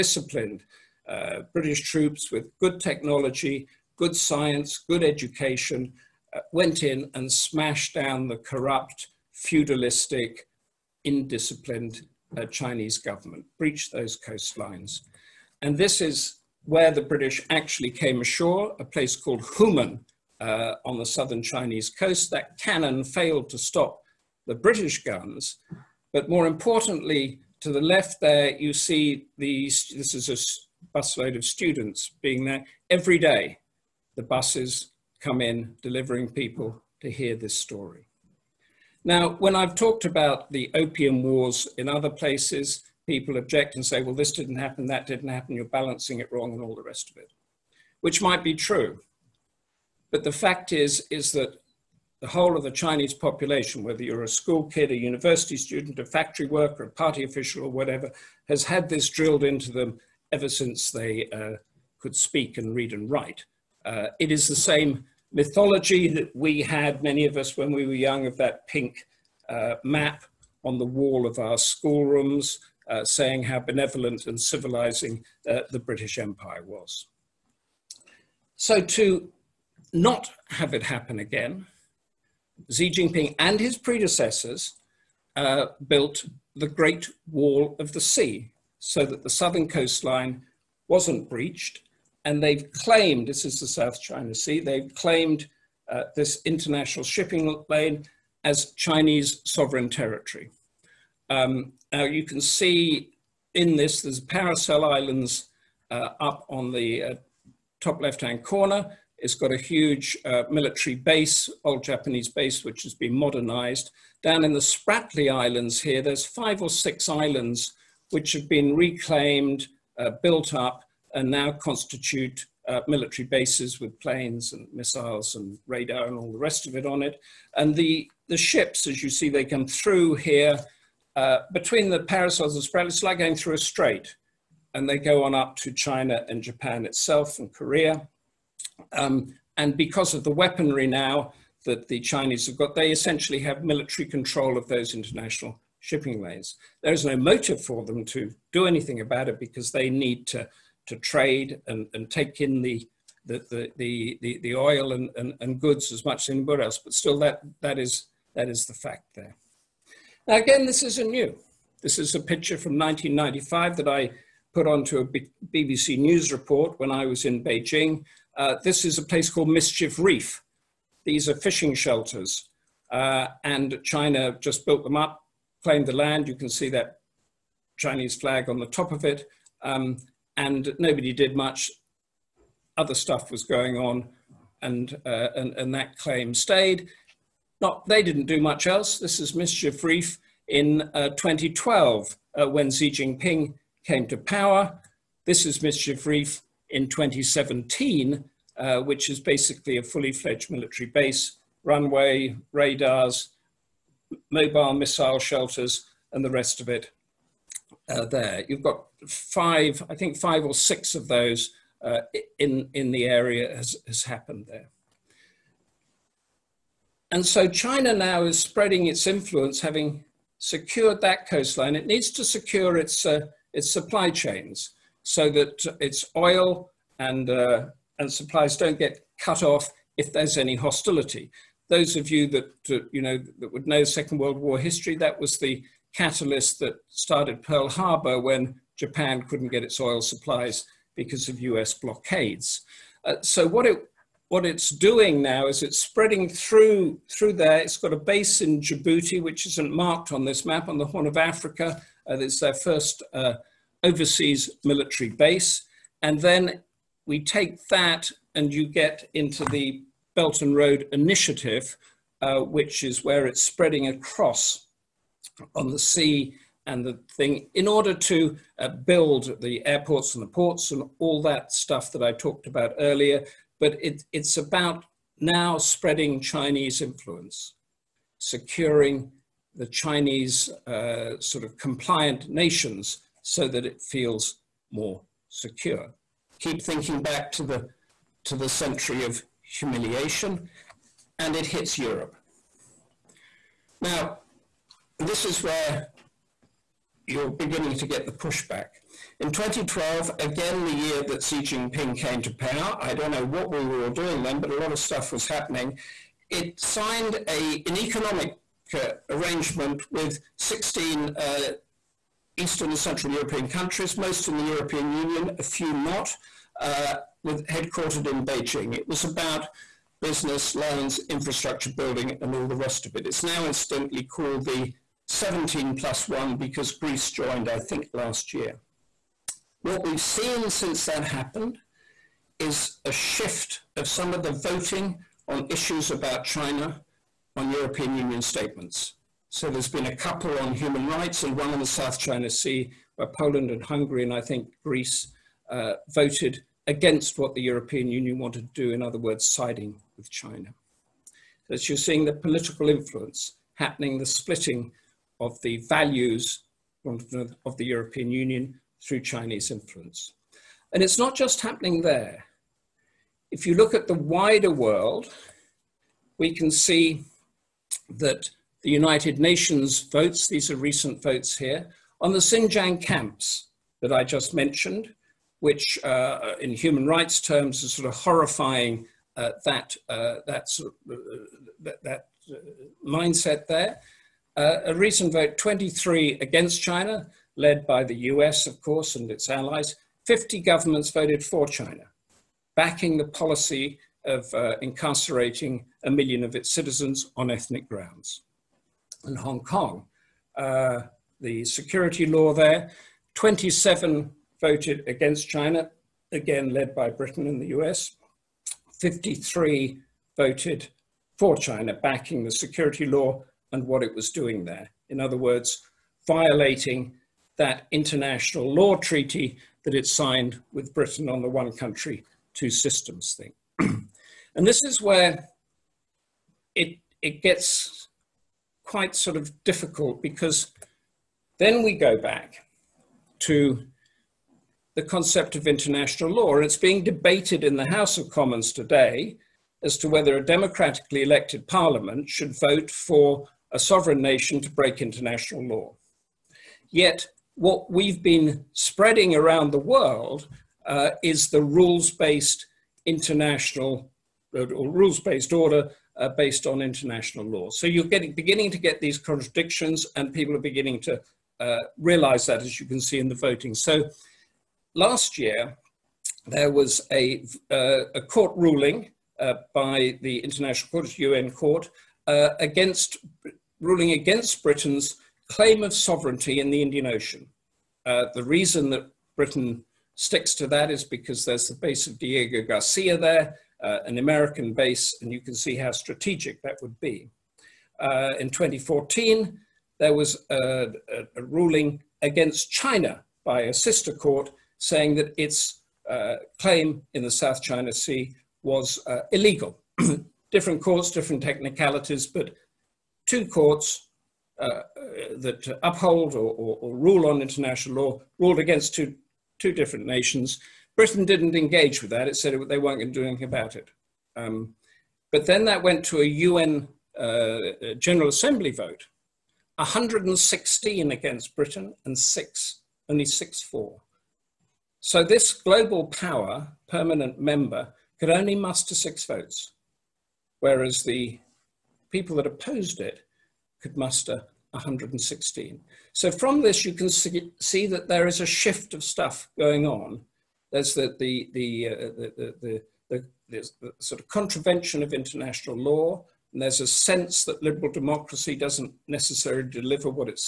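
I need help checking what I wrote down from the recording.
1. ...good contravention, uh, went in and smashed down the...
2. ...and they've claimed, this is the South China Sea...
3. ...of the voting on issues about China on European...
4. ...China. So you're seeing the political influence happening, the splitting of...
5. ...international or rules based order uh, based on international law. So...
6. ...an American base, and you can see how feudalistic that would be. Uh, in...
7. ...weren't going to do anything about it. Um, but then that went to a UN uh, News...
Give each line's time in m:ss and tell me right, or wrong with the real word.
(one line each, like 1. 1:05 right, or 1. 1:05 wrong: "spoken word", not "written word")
1. 0:04 wrong: "education", not "contravention"
2. 1:32 right
3. 5:34 right
4. 5:50 right
5. 7:32 right
6. 8:03 wrong: "strategic", not "feudalistic"
7. 8:32 wrong: "General", not "News".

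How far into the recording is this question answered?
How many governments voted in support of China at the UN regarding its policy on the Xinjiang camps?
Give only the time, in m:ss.
6:30.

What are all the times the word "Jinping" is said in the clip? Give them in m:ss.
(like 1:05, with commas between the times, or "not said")
1:22, 3:12, 5:01.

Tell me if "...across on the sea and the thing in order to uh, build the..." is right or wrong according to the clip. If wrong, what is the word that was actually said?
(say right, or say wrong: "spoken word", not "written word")
right.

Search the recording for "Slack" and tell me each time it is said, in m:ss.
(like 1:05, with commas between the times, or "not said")
not said.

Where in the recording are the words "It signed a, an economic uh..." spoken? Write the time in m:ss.
5:06.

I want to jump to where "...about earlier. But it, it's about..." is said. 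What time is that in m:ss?
4:32.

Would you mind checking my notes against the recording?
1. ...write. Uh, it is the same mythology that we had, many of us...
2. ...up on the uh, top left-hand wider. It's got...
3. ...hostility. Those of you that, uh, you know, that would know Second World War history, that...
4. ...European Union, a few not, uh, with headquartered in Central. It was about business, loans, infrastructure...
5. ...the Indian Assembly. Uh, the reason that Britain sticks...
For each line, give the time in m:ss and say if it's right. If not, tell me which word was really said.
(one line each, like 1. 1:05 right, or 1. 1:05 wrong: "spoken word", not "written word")
1. 1:03 right
2. 1:46 wrong: "corner", not "wider"
3. 3:50 right
4. 5:14 wrong: "Beijing", not "Central"
5. 7:56 wrong: "Ocean", not "Assembly".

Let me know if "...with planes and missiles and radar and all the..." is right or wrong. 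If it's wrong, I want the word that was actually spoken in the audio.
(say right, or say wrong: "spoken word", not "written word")
right.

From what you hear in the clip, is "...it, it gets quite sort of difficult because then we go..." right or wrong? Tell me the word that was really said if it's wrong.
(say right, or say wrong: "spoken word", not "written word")
right.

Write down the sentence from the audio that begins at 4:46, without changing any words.
Keep thinking back to the, to the century of humiliation and it hits Europe.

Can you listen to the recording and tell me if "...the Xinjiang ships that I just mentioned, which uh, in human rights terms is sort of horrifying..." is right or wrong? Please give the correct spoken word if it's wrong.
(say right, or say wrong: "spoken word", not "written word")
wrong: "camps", not "ships".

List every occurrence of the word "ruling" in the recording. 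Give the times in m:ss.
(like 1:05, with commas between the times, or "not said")
7:48, 7:53, 8:11.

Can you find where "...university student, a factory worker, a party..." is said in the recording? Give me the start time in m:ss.
0:54.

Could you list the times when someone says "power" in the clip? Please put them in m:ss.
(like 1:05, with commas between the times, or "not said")
3:14, 5:02, 8:45.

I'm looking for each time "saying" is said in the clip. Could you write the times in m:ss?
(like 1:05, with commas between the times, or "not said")
1:13, 8:14.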